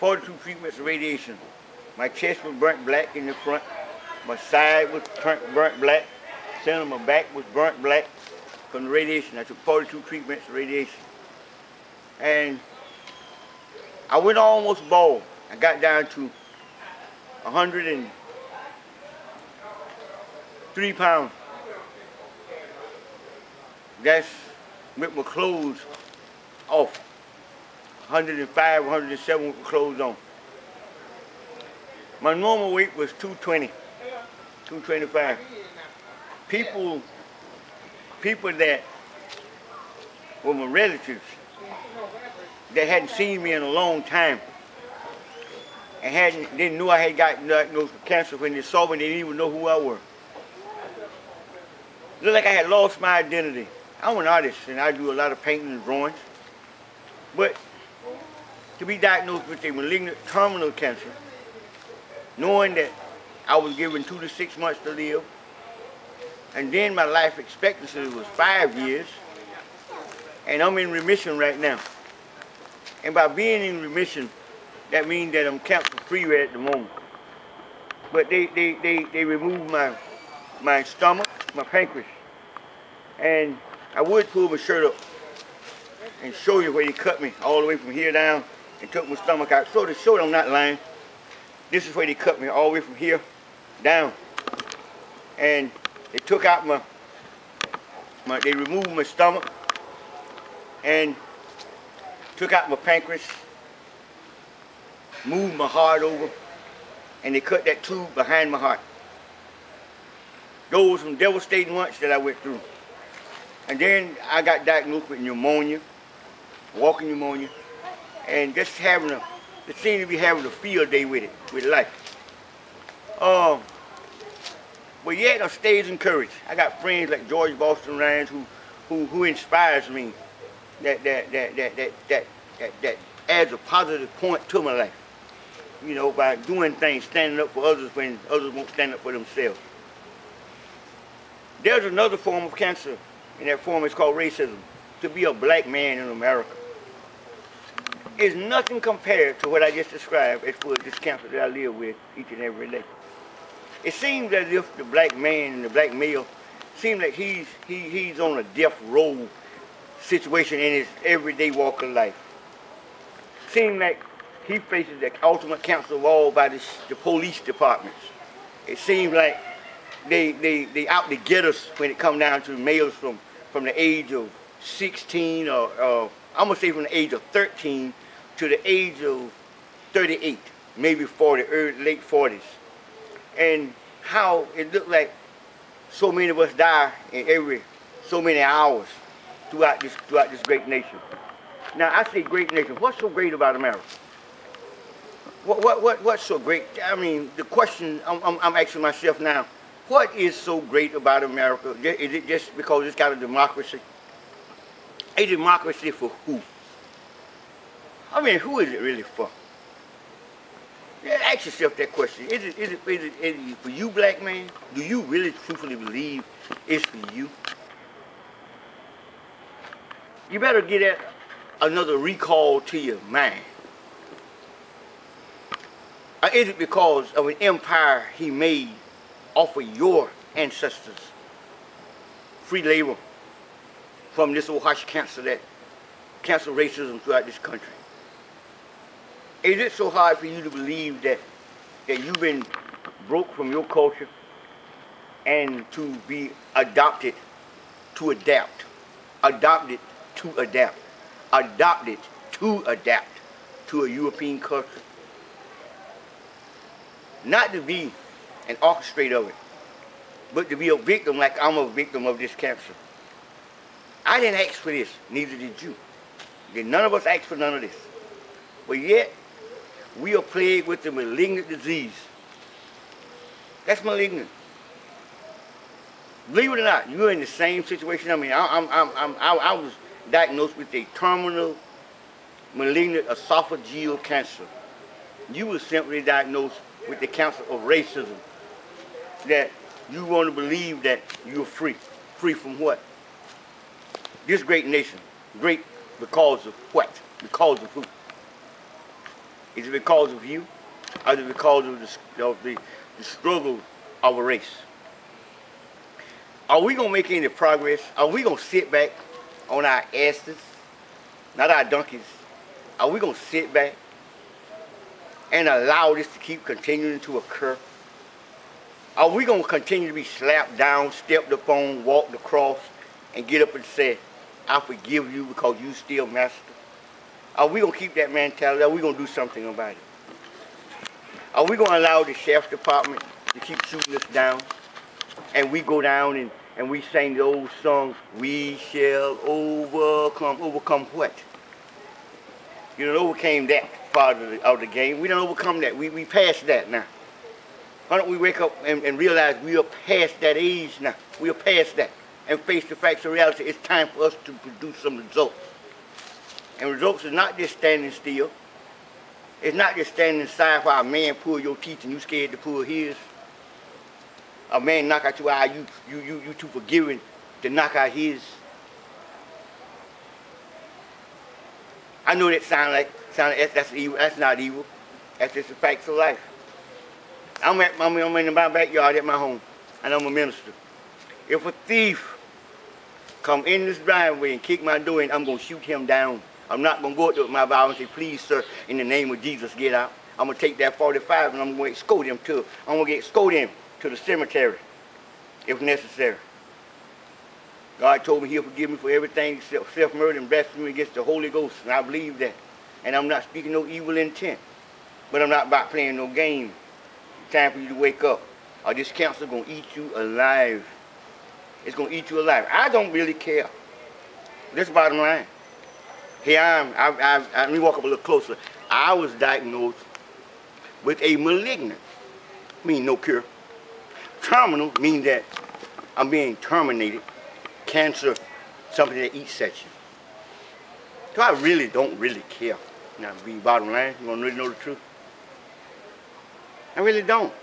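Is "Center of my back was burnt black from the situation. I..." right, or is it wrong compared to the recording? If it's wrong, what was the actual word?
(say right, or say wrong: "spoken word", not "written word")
wrong: "radiation", not "situation".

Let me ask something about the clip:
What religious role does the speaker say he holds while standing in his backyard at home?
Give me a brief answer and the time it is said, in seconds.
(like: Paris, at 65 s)
Minister, at 380 s.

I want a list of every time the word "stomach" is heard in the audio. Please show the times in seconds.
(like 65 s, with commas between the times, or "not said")
80 s, 89 s, 99 s.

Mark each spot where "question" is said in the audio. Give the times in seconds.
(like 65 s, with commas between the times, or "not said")
197 s, 211 s.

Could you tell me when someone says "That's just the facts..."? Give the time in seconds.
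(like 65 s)
375 s.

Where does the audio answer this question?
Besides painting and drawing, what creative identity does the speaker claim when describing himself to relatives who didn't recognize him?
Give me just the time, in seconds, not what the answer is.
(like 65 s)
54 s.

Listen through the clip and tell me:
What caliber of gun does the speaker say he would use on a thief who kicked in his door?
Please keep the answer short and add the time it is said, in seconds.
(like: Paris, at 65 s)
45, at 390 s.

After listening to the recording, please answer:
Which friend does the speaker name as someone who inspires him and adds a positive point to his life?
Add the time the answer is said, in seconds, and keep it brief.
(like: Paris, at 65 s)
George Boston Rawls, at 127 s.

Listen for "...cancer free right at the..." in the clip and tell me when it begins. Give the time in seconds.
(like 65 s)
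75 s.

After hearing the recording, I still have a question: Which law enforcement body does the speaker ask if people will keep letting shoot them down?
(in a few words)
Sheriff's department.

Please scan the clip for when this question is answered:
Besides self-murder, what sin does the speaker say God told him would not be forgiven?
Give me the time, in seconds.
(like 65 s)
400 s.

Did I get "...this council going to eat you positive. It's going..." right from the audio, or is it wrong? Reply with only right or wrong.
wrong.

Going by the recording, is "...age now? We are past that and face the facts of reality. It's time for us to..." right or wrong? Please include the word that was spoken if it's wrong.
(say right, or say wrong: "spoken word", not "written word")
right.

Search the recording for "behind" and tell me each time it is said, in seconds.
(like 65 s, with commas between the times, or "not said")
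108 s.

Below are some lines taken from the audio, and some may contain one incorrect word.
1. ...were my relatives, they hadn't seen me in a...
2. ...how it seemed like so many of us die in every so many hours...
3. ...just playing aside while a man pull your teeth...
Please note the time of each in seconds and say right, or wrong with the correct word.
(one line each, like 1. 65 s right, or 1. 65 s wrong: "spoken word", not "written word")
1. 40 s right
2. 184 s wrong: "looked", not "seemed"
3. 359 s wrong: "standing", not "playing".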